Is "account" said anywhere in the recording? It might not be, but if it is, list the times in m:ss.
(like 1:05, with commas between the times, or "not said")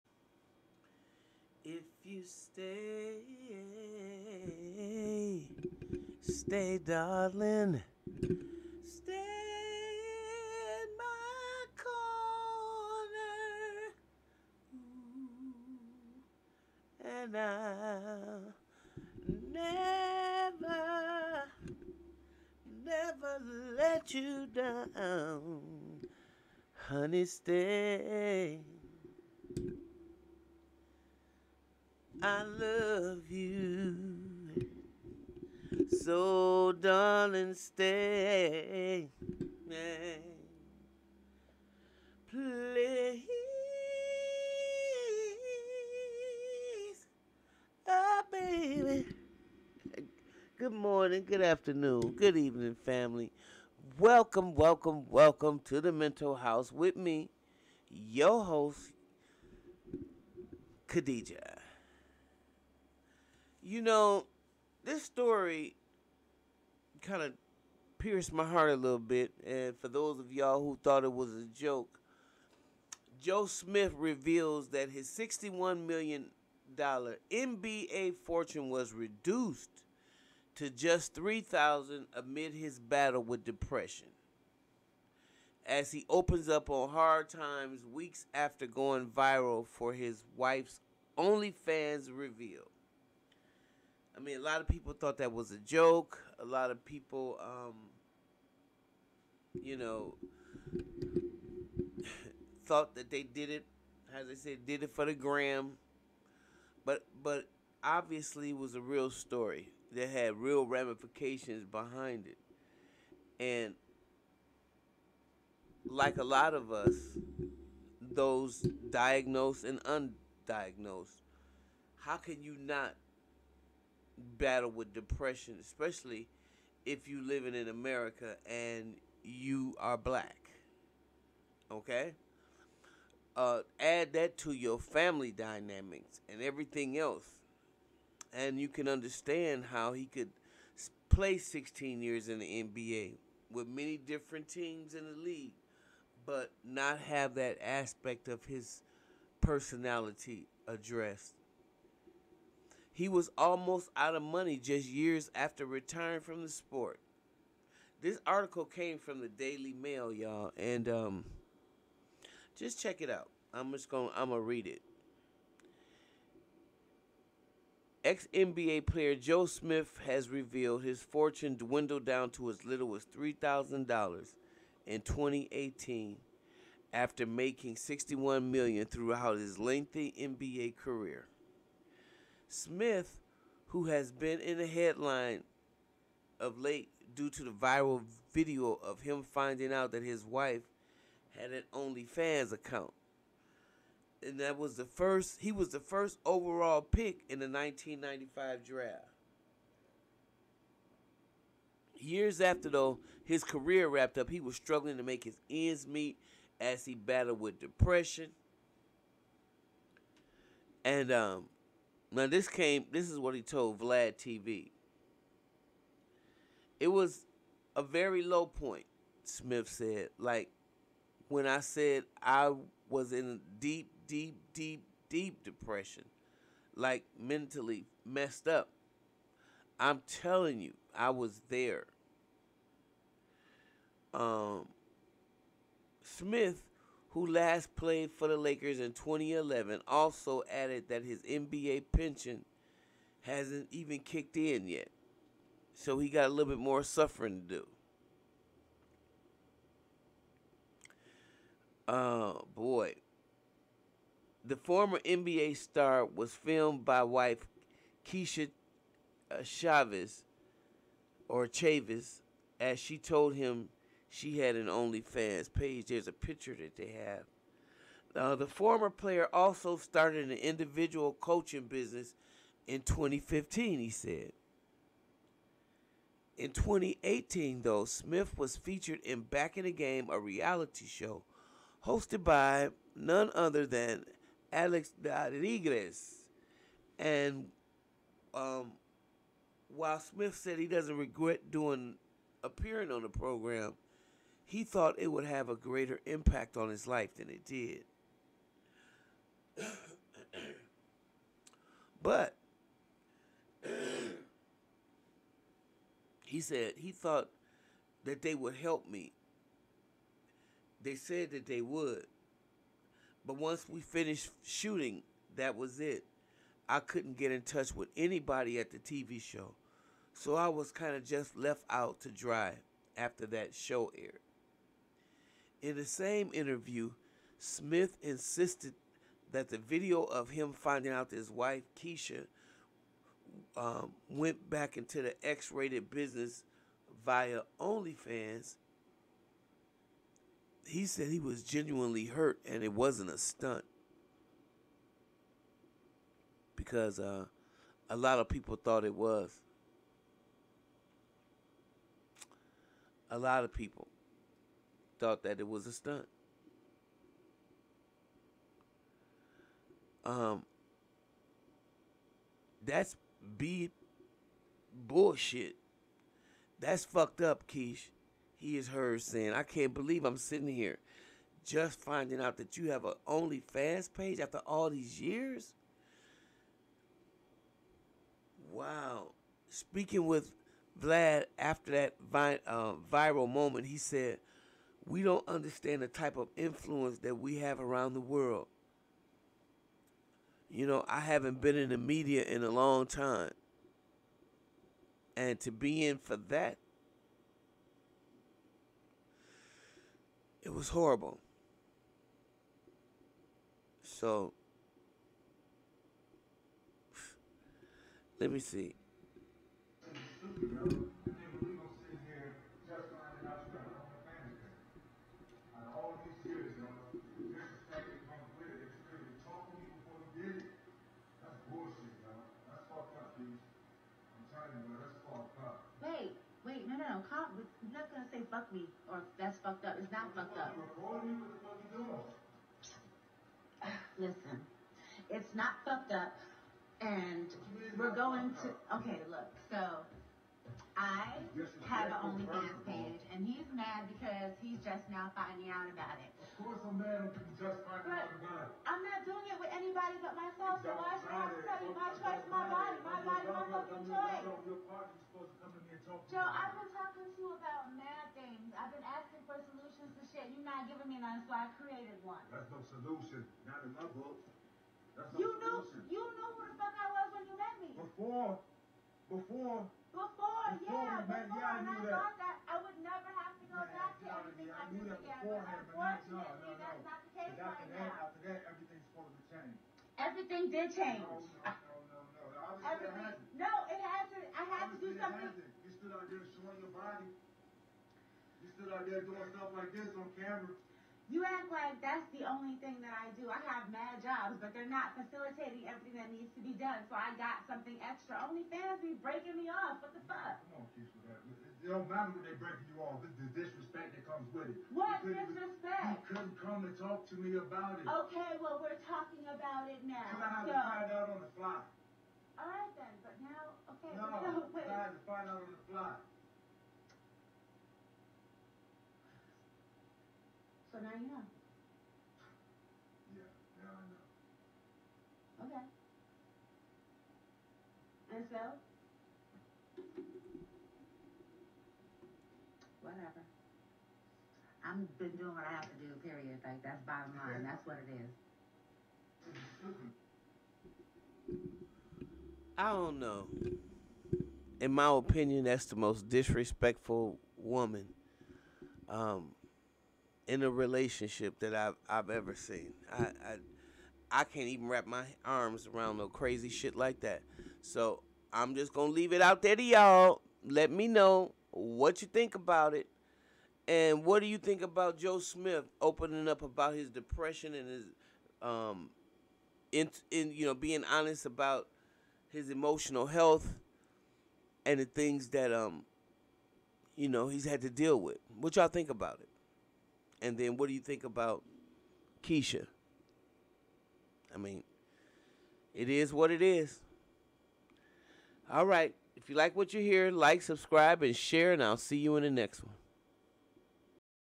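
3:12.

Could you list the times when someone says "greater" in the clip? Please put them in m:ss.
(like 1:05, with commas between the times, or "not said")
4:55.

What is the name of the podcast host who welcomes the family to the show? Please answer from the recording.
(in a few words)
Khadijah.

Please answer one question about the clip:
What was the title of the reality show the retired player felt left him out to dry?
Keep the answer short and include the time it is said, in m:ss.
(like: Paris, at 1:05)
Back in the Game, at 4:39.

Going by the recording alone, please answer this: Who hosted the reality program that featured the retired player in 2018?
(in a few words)
Alex Rodriguez.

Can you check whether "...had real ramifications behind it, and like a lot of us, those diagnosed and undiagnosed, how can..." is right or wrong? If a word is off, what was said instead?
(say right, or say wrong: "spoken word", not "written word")
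right.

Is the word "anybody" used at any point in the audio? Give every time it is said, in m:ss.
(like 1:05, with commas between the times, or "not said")
5:17, 7:29.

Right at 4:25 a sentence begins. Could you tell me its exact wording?
There's a picture that they have.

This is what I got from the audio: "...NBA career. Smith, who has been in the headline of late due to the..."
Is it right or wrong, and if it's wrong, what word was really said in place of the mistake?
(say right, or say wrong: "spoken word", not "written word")
right.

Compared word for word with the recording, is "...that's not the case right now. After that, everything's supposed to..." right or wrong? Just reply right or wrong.
right.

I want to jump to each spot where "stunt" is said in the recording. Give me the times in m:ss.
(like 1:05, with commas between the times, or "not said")
5:43, 5:55.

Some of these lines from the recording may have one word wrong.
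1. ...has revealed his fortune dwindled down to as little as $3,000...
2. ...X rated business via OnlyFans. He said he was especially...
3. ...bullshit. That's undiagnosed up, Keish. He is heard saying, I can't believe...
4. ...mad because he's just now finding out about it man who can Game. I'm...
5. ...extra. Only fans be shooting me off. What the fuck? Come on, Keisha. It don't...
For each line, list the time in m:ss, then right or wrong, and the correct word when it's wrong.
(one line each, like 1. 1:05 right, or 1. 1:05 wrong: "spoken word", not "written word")
1. 2:50 right
2. 5:35 wrong: "genuinely", not "especially"
3. 6:04 wrong: "fucked", not "undiagnosed"
4. 7:23 wrong: "God", not "Game"
5. 8:17 wrong: "breaking", not "shooting".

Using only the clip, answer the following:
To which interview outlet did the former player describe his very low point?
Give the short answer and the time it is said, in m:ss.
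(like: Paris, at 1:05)
Vlad TV, at 3:33.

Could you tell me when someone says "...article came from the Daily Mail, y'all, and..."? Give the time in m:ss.
2:38.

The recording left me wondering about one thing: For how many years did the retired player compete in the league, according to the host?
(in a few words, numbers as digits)
16.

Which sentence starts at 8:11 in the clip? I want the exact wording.
You act like that's the only thing that I do.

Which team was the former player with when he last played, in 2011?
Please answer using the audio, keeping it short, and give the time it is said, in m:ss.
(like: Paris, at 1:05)
Lakers, at 3:58.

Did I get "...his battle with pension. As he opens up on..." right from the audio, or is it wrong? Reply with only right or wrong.
wrong.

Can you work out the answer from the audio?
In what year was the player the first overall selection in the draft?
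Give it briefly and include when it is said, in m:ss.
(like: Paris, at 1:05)
1995, at 3:17.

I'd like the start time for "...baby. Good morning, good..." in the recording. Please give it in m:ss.
0:48.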